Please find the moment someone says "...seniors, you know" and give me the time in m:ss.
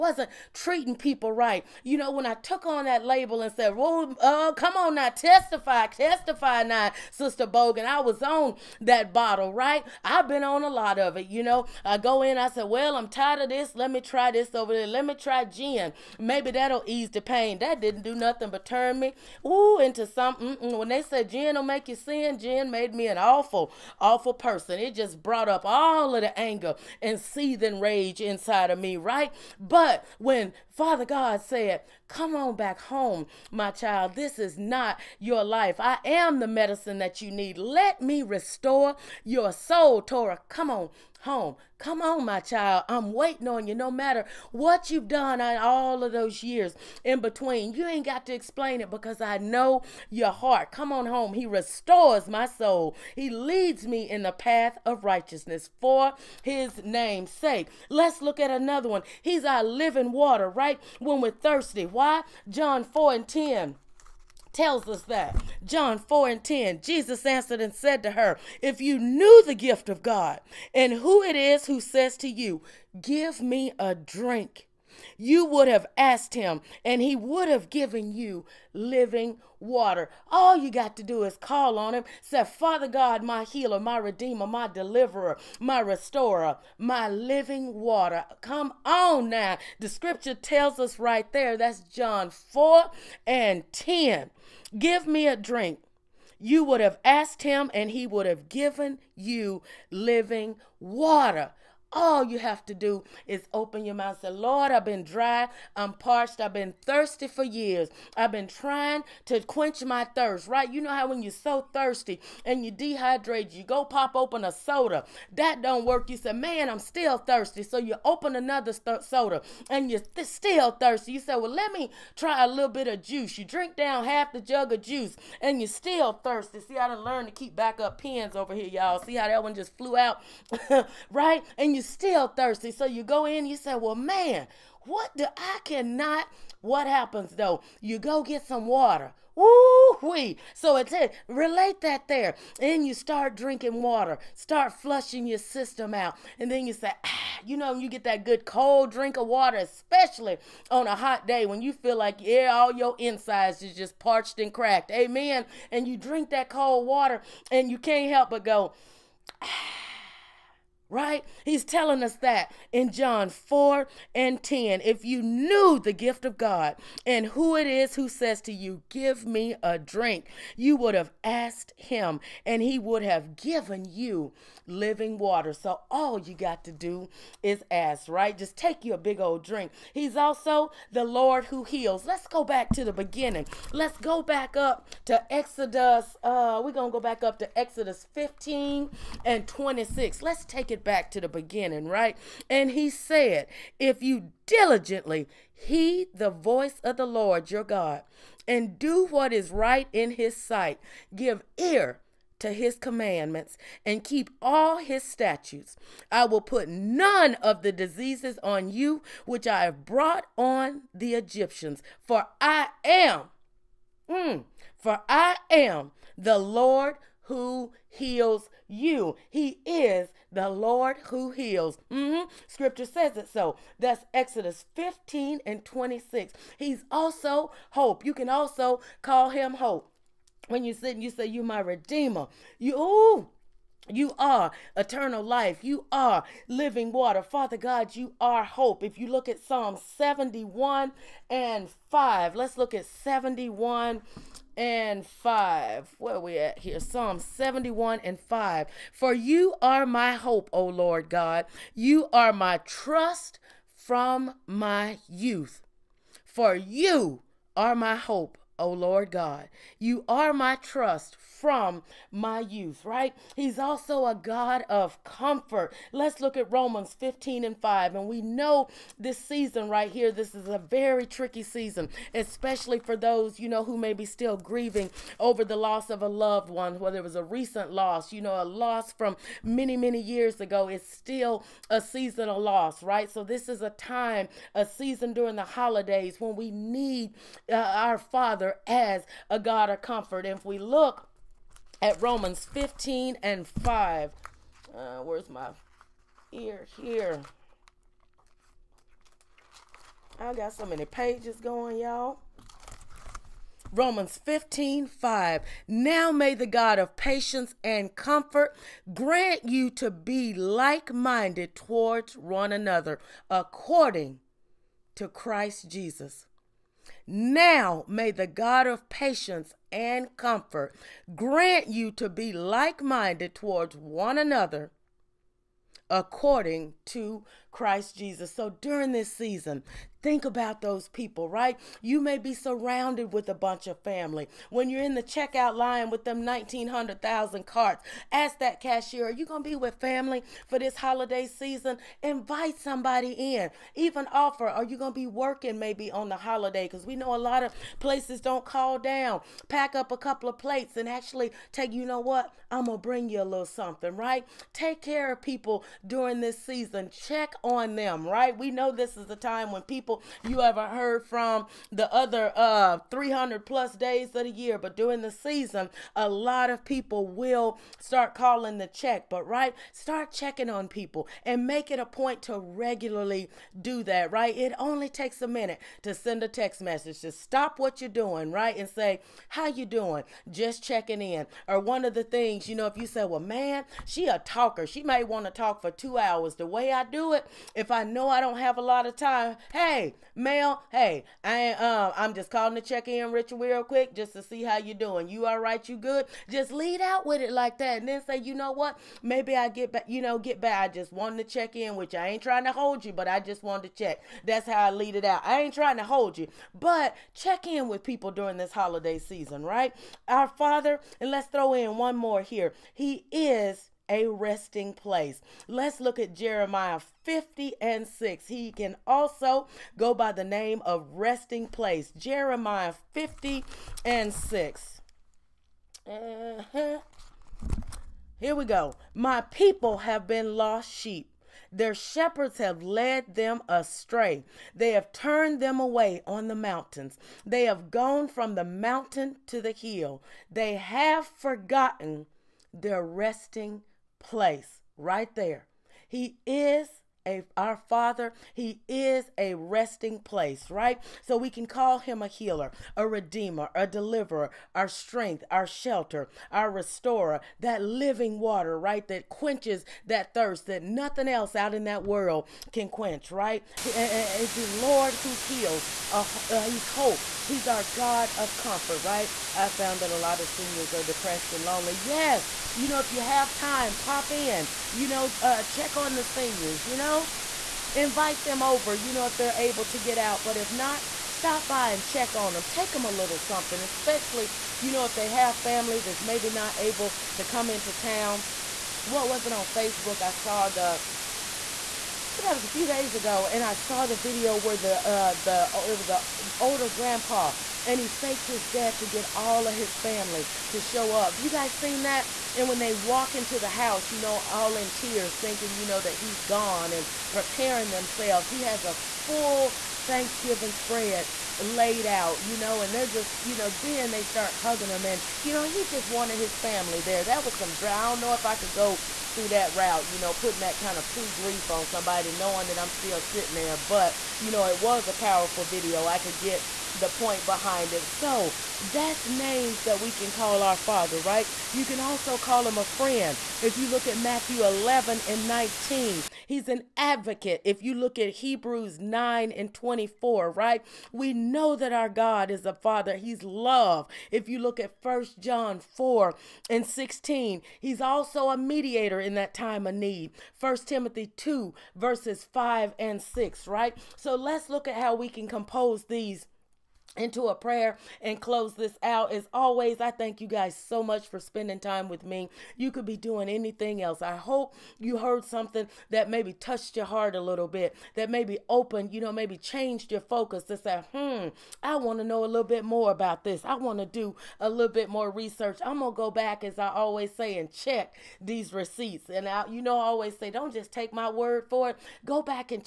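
7:56.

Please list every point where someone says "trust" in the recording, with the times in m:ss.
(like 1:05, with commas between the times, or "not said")
4:12, 4:20.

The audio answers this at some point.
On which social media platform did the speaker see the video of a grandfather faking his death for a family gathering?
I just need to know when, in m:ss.
8:09.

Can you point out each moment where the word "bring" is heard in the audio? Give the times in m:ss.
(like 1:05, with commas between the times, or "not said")
5:52.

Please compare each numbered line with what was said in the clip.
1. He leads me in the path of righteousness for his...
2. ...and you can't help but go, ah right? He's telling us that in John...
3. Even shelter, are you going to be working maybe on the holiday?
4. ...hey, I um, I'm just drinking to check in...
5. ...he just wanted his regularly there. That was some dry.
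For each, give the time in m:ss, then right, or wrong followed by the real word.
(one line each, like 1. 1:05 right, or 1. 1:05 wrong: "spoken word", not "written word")
1. 0:53 right
2. 2:37 right
3. 5:43 wrong: "offer", not "shelter"
4. 6:30 wrong: "calling", not "drinking"
5. 8:35 wrong: "family", not "regularly".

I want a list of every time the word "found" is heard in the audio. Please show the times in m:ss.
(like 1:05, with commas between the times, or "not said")
7:49.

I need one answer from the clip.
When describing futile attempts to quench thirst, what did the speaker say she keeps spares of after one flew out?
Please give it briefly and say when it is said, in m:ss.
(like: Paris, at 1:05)
Pens, at 2:07.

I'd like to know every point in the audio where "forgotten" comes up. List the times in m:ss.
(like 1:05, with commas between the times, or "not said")
7:21.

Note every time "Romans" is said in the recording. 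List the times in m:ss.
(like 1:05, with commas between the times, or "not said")
4:26, 4:52, 5:03.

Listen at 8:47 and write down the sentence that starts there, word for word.
So that's names that we can call our Father, right?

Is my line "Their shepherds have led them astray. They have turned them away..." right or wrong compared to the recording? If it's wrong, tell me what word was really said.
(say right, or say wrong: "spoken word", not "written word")
right.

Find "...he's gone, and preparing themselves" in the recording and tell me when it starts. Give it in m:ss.
8:25.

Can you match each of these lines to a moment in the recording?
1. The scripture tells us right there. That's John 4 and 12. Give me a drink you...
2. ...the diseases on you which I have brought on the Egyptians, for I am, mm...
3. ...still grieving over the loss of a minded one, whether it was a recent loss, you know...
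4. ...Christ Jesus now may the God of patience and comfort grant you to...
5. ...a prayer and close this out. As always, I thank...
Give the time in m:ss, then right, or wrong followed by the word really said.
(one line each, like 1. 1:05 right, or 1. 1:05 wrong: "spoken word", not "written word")
1. 1:29 wrong: "10", not "12"
2. 3:27 right
3. 4:34 wrong: "loved", not "minded"
4. 5:15 right
5. 9:17 right.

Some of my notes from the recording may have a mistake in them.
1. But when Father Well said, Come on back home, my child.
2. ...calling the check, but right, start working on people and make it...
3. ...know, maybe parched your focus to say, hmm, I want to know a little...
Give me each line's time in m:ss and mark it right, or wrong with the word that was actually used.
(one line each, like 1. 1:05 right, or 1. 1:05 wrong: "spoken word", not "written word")
1. 0:29 wrong: "God", not "Well"
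2. 6:08 wrong: "checking", not "working"
3. 9:29 wrong: "changed", not "parched".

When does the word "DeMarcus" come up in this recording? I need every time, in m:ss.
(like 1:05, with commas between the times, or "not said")
not said.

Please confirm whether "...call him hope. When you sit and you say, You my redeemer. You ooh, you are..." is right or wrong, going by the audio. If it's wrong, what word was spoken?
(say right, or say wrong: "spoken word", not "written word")
right.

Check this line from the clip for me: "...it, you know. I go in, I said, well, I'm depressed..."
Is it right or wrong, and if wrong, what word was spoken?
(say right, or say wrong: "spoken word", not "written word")
wrong: "tired", not "depressed".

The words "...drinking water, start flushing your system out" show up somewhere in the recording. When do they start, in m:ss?
2:23.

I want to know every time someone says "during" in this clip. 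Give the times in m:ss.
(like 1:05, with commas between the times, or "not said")
4:45, 5:28, 5:55, 6:04, 6:48.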